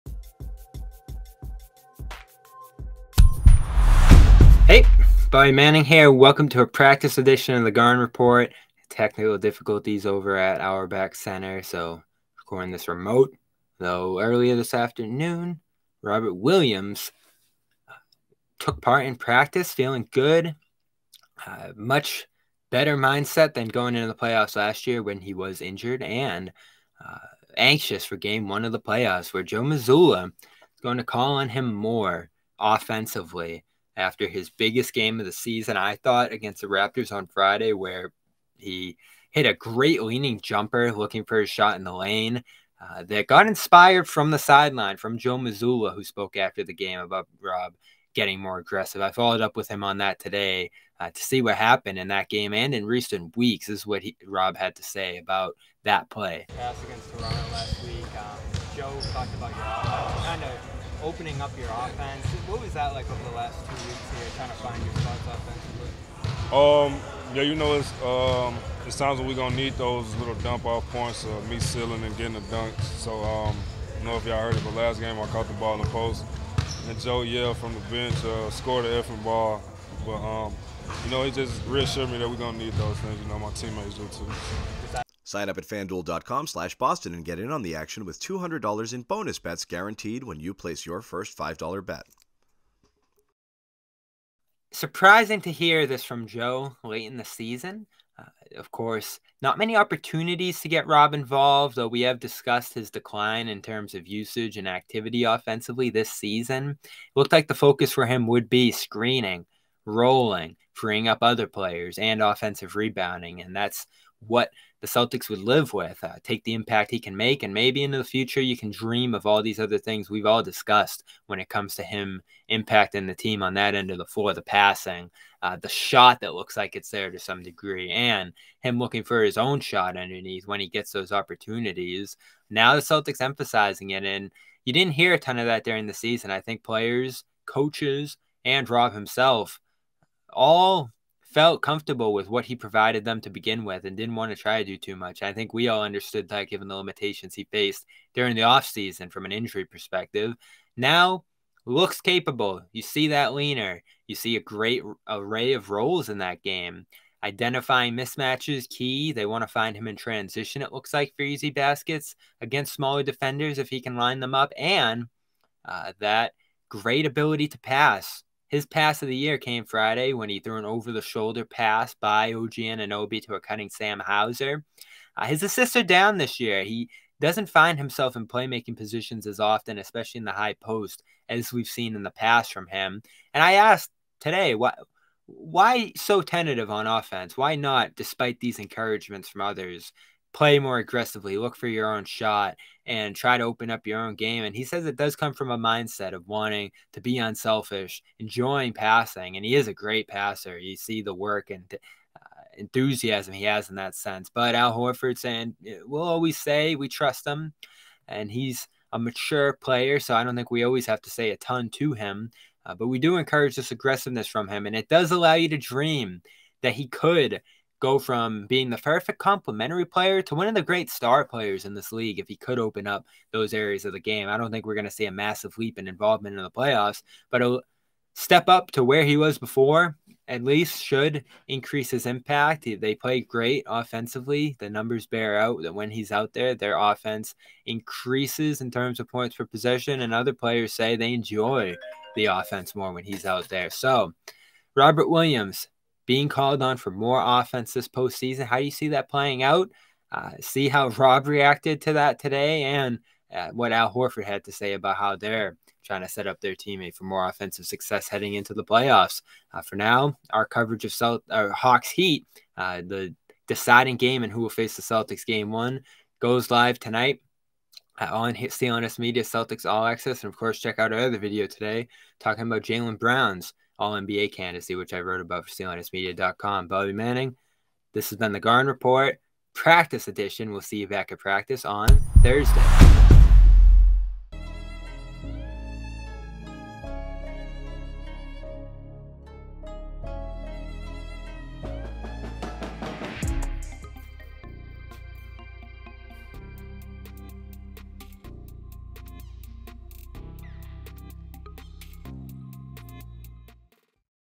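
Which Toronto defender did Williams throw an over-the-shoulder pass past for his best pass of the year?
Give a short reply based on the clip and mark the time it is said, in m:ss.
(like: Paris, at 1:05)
OG Anunoby, at 2:52.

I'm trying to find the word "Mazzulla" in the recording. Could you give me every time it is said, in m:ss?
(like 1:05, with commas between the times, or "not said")
0:29, 0:45.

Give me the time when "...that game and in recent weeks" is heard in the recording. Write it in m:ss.
0:52.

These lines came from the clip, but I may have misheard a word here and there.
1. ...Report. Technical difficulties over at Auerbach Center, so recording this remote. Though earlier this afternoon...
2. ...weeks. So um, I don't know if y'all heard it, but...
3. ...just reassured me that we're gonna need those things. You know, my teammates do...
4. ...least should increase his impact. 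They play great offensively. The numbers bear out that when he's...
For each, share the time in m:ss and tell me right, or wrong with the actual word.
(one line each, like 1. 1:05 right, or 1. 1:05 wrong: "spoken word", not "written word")
1. 0:08 right
2. 1:12 wrong: "dunks", not "weeks"
3. 1:21 right
4. 3:50 right.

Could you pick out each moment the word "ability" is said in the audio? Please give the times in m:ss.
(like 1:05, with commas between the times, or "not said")
2:47.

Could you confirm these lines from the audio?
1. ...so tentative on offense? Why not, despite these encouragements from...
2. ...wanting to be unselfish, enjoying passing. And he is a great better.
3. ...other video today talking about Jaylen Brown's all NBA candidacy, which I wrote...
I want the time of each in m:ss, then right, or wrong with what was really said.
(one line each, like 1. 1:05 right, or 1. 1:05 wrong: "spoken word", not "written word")
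1. 3:05 right
2. 3:16 wrong: "passer", not "better"
3. 4:30 right.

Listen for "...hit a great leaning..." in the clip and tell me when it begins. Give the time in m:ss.
0:39.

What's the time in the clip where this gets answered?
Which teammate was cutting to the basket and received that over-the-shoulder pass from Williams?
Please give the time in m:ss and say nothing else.
2:53.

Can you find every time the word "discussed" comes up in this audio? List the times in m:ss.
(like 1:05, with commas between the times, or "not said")
1:42, 2:00.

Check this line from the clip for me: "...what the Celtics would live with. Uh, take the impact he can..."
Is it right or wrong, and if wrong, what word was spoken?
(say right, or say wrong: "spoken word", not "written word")
right.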